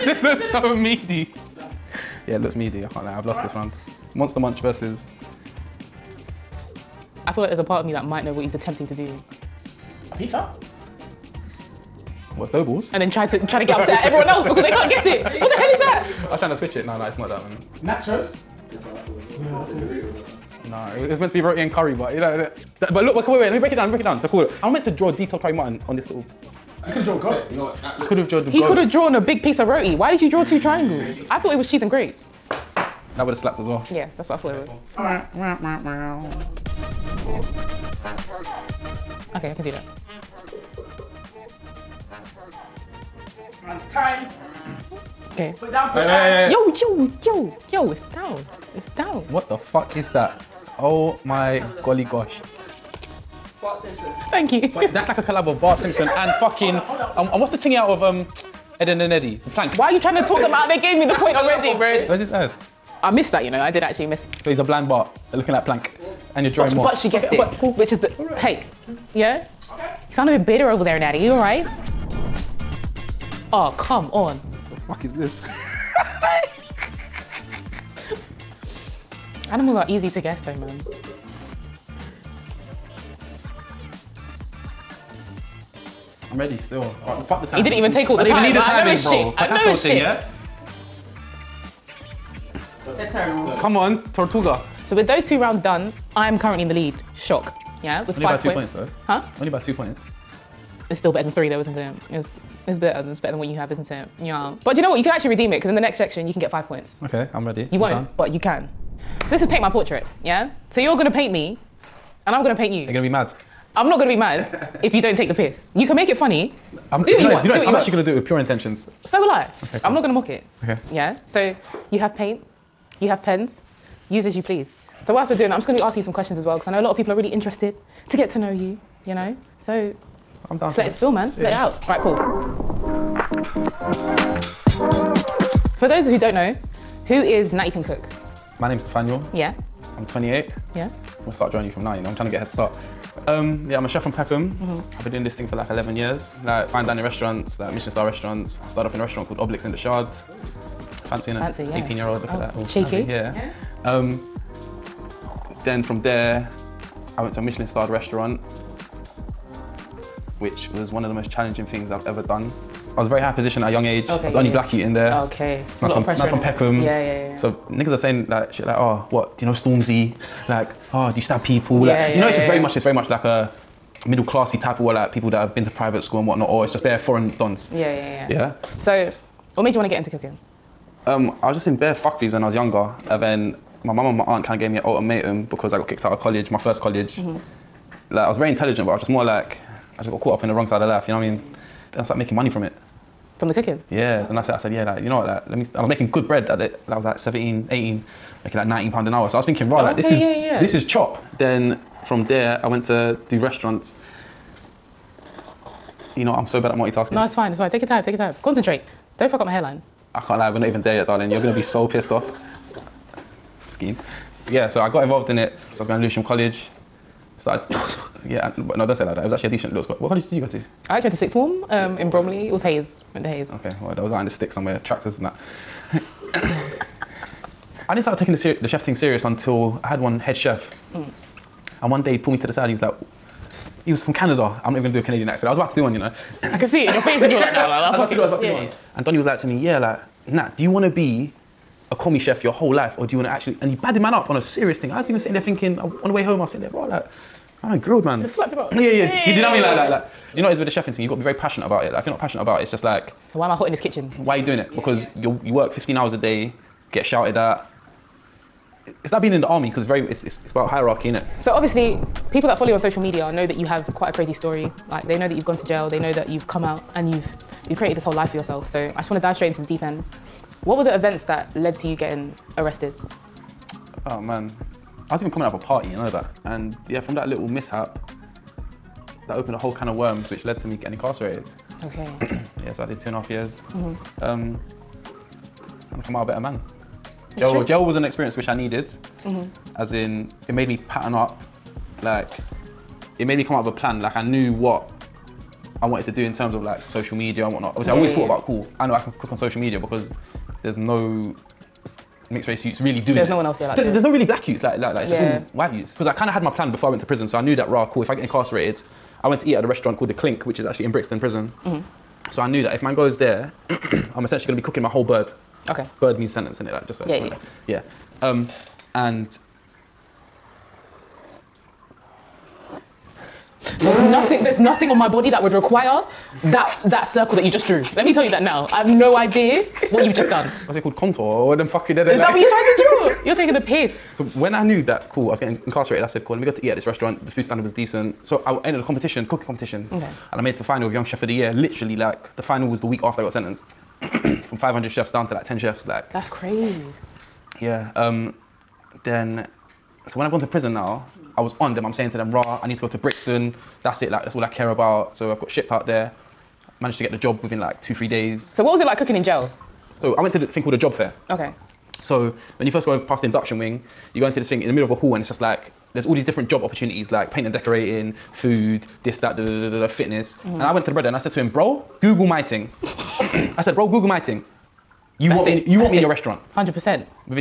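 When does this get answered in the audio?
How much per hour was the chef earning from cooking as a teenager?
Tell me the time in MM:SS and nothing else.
03:18.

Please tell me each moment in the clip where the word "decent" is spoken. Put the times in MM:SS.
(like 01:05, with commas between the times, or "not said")
03:39, 05:37.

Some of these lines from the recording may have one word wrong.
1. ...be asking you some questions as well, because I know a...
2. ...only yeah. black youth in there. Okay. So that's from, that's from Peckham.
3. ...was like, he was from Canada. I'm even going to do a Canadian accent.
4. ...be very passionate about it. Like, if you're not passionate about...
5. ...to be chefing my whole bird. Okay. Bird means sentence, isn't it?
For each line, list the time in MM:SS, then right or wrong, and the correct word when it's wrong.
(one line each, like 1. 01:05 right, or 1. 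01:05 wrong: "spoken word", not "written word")
1. 02:05 right
2. 02:44 right
3. 03:52 right
4. 04:11 right
5. 05:14 wrong: "cooking", not "chefing".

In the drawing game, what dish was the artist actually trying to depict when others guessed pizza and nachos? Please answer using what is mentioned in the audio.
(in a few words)
Roti and curry.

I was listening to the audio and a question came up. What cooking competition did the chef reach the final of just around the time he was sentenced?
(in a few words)
Young Chef of the Year.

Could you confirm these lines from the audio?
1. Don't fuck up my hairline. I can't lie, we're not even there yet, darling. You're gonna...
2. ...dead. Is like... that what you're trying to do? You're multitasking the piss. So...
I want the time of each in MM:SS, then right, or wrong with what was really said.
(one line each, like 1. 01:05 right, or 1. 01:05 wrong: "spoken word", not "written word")
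1. 03:29 right
2. 05:31 wrong: "taking", not "multitasking".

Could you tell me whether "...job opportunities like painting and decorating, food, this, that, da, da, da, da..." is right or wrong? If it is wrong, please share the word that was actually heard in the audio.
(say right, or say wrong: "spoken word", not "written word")
right.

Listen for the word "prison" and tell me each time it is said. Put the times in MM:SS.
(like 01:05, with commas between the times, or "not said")
05:07, 05:11, 05:50.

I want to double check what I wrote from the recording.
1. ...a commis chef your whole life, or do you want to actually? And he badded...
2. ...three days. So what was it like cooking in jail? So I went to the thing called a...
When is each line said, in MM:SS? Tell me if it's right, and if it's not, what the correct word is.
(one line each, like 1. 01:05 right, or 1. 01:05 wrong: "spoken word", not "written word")
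1. 04:01 right
2. 05:57 right.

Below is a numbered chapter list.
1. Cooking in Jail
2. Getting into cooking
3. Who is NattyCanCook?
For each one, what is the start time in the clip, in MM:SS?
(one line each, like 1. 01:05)
1. 04:21
2. 03:27
3. 02:12.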